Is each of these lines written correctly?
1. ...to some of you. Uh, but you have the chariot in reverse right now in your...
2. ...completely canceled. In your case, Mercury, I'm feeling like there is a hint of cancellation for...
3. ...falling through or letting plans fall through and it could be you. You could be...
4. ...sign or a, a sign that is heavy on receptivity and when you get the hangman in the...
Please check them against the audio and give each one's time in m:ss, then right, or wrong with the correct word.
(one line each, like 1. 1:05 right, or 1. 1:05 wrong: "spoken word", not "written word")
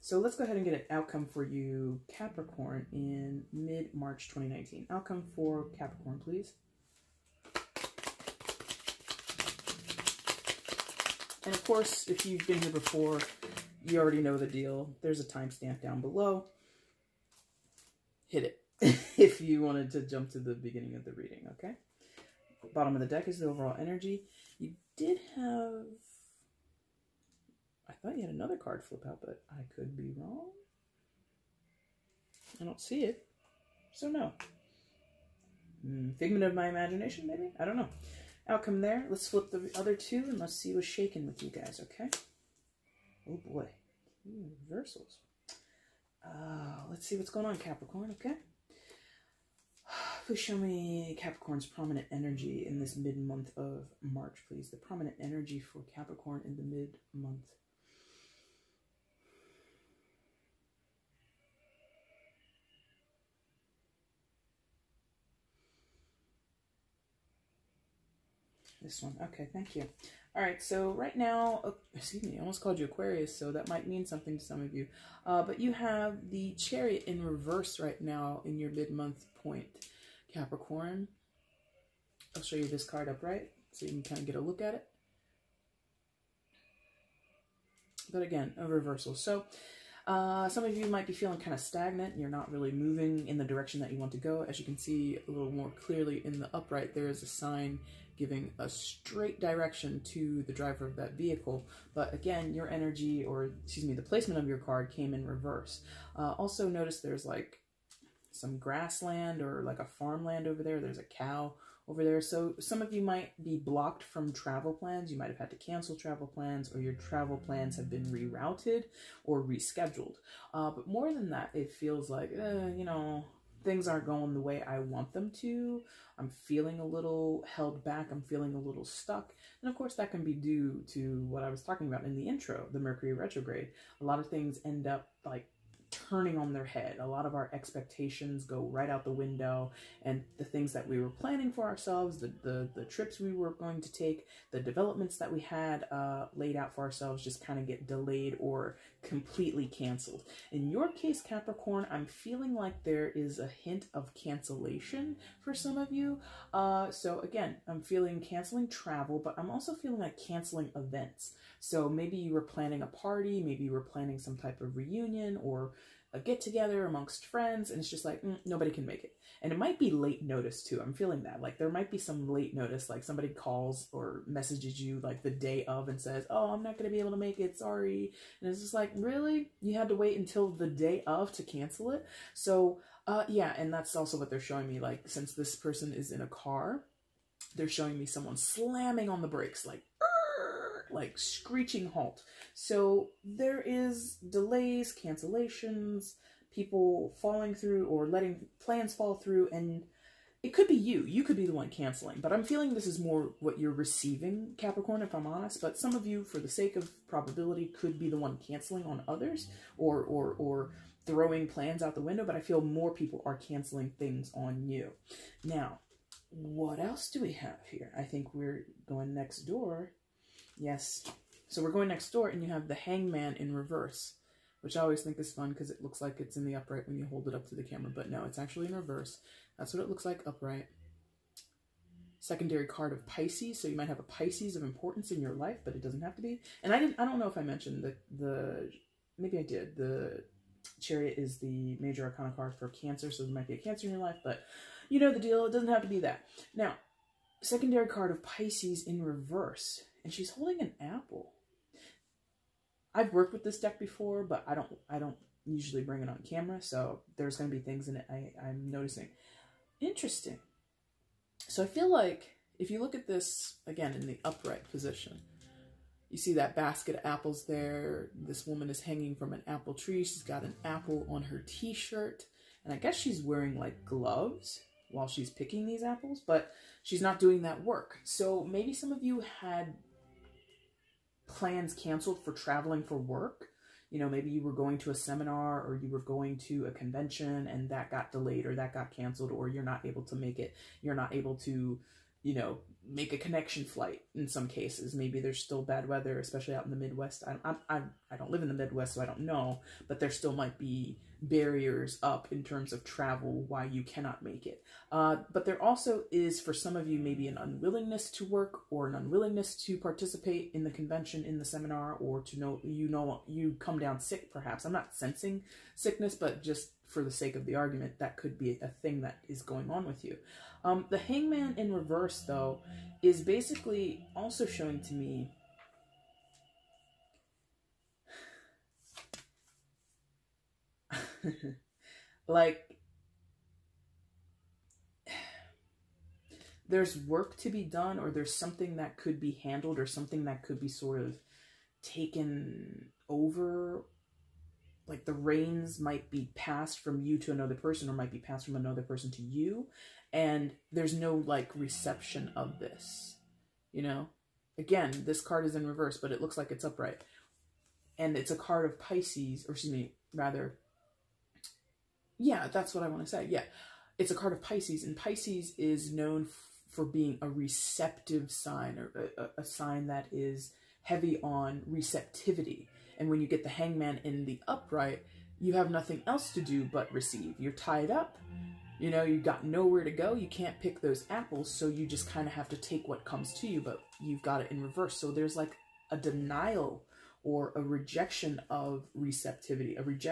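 1. 1:14 right
2. 2:29 wrong: "Capricorn", not "Mercury"
3. 3:17 right
4. 6:08 right.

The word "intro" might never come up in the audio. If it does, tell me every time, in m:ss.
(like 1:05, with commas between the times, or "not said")
2:12.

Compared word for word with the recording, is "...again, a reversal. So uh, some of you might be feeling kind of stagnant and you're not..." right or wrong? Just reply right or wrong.
right.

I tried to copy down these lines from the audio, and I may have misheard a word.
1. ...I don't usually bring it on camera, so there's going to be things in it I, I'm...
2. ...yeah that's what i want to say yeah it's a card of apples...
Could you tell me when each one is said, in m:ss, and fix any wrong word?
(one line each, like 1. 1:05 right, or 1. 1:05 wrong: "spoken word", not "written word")
1. 4:14 right
2. 6:02 wrong: "pisces", not "apples".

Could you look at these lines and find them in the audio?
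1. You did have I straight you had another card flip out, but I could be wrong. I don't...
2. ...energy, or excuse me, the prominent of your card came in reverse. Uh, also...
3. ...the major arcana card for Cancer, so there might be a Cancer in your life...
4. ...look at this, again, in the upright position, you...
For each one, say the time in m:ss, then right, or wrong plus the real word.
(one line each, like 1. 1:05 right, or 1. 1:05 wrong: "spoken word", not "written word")
1. 0:24 wrong: "thought", not "straight"
2. 1:42 wrong: "placement", not "prominent"
3. 4:01 right
4. 4:22 right.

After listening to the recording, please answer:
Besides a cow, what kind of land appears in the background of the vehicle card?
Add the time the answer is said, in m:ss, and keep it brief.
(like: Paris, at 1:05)
farmland, at 1:49.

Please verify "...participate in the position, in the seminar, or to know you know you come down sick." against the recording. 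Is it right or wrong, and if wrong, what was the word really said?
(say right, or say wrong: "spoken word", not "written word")
wrong: "convention", not "position".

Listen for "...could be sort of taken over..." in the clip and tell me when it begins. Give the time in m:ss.
5:40.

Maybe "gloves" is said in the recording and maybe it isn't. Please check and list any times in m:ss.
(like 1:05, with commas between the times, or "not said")
4:33.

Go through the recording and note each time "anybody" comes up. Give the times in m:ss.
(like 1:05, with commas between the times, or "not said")
not said.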